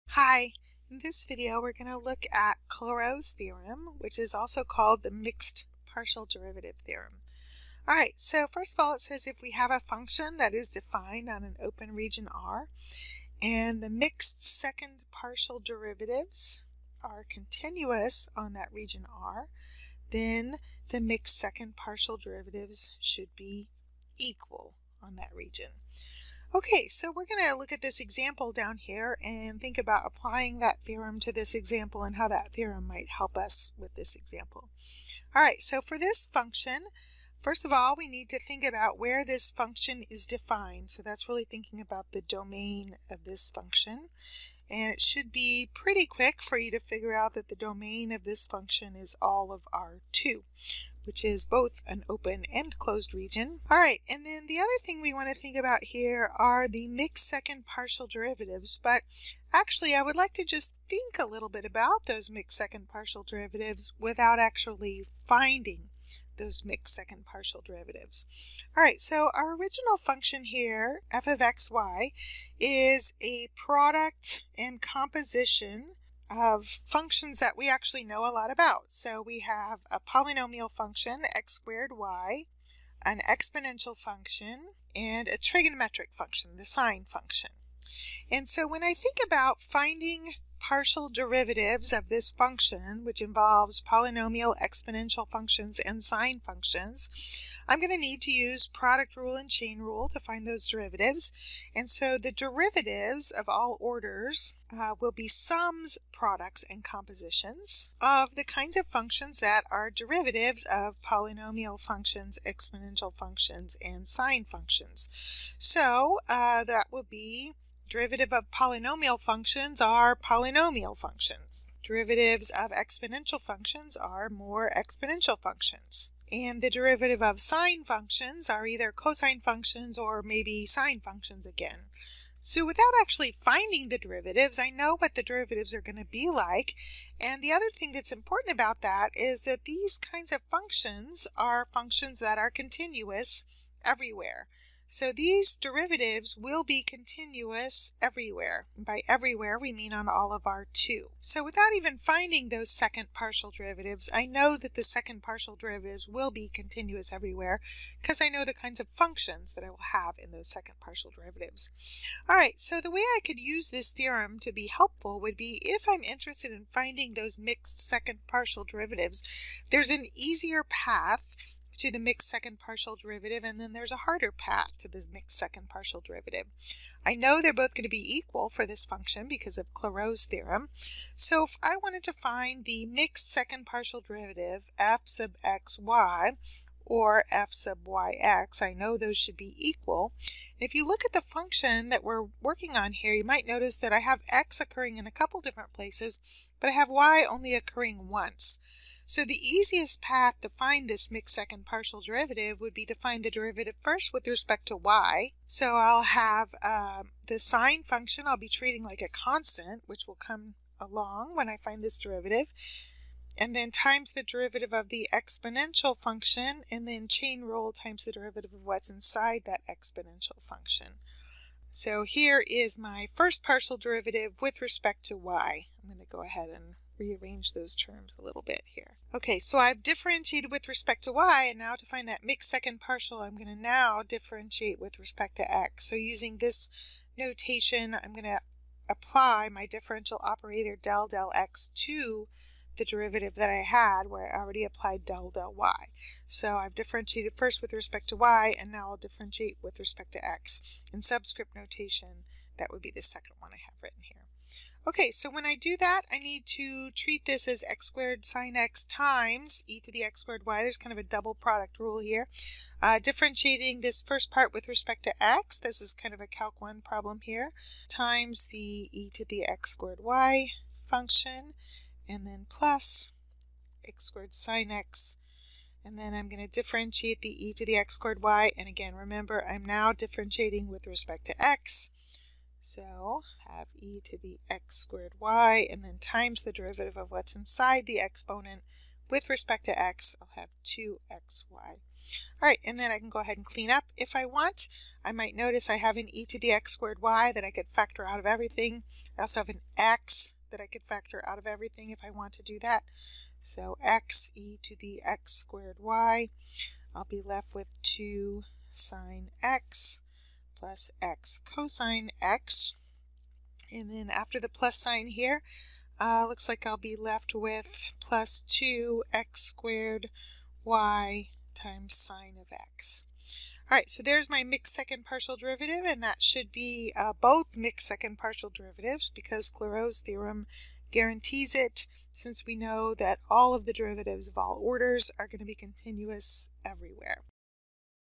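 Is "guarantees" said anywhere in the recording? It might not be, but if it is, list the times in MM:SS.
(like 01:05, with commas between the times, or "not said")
05:30.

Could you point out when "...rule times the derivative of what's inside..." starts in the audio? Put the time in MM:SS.
03:37.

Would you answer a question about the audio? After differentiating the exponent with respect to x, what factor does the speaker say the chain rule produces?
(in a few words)
2xy.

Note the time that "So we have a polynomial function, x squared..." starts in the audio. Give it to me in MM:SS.
01:18.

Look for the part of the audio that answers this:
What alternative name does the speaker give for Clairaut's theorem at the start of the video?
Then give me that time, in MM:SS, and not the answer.
00:05.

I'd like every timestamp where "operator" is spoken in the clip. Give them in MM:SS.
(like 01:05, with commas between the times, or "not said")
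04:00.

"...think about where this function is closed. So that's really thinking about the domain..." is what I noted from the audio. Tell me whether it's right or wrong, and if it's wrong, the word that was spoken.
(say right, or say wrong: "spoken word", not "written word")
wrong: "defined", not "closed".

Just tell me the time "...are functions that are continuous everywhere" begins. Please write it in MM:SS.
02:21.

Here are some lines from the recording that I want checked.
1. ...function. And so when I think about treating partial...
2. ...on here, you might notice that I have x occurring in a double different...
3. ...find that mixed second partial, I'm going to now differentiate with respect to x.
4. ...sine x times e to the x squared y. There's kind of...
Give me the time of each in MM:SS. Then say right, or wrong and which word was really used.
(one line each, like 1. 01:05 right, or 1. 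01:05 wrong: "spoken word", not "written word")
1. 01:27 wrong: "finding", not "treating"
2. 03:12 wrong: "couple", not "double"
3. 03:51 right
4. 04:18 right.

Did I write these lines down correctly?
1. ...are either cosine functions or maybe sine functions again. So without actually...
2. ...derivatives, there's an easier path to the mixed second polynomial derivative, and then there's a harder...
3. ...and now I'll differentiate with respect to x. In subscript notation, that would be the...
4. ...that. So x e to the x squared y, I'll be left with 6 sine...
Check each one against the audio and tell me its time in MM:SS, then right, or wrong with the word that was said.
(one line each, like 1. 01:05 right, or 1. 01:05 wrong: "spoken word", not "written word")
1. 02:08 right
2. 02:48 wrong: "partial", not "polynomial"
3. 04:08 right
4. 05:02 wrong: "2", not "6".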